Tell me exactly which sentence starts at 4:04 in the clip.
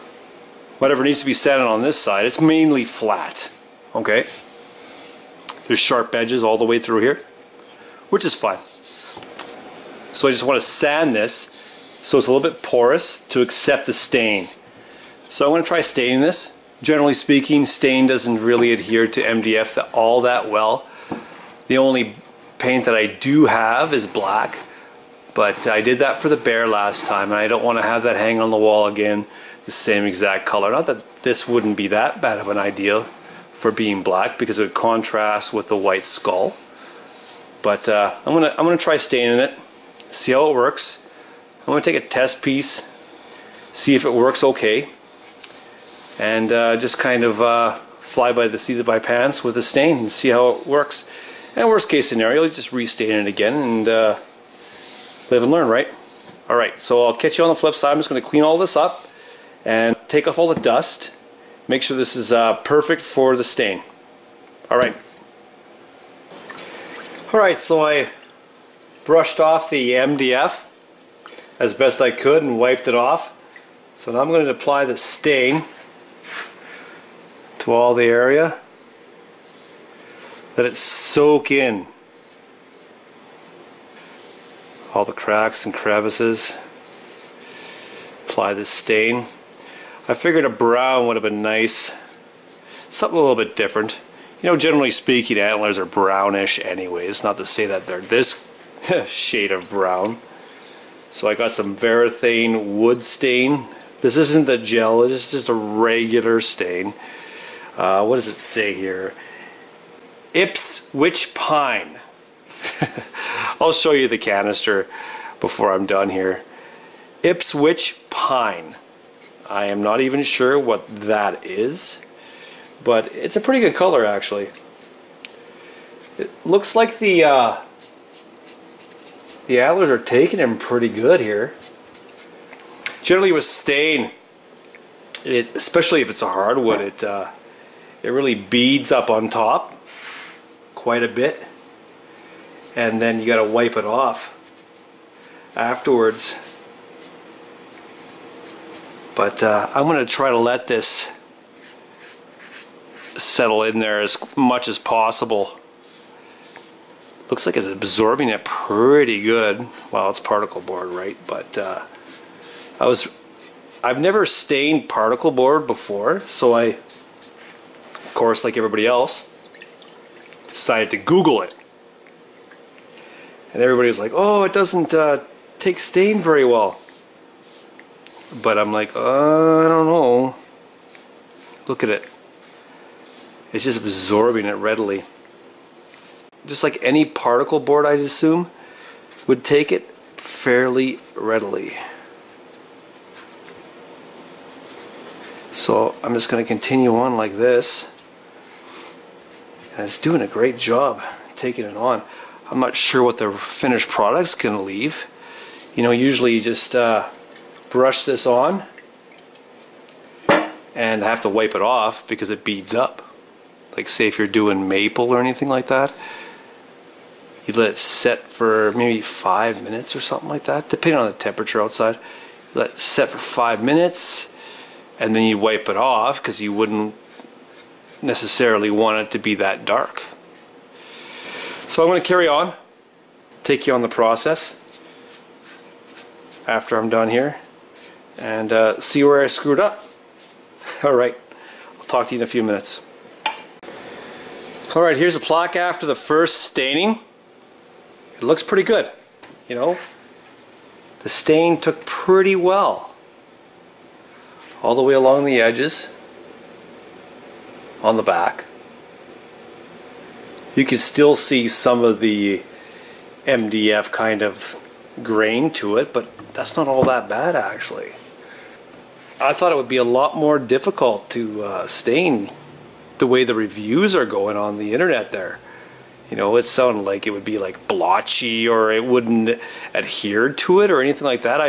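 Alright, here's the plaque after the first staining.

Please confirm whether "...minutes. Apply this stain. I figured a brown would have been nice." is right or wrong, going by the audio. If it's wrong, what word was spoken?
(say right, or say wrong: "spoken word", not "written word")
wrong: "crevices", not "minutes".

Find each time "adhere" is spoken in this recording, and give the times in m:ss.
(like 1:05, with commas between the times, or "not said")
0:18, 4:39.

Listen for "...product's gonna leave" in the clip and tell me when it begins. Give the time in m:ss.
3:23.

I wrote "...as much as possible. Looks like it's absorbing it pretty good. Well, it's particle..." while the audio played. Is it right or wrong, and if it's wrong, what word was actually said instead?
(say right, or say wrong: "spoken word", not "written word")
right.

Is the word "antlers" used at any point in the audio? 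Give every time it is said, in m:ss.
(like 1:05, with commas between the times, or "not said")
1:35, 2:09.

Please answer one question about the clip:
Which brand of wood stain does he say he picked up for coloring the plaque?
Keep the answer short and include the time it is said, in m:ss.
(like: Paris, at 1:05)
Varathane, at 1:41.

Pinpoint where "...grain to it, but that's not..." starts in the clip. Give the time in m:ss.
4:25.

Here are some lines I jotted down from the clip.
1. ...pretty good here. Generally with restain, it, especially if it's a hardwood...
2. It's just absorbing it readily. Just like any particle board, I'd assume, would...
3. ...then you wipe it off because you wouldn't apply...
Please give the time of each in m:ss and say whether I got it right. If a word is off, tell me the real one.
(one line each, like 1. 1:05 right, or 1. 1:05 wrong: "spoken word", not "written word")
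1. 2:10 wrong: "stain", not "restain"
2. 3:03 right
3. 3:45 wrong: "necessarily", not "apply".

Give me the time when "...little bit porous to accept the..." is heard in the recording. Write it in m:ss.
0:12.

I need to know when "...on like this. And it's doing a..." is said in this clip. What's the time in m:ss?
3:16.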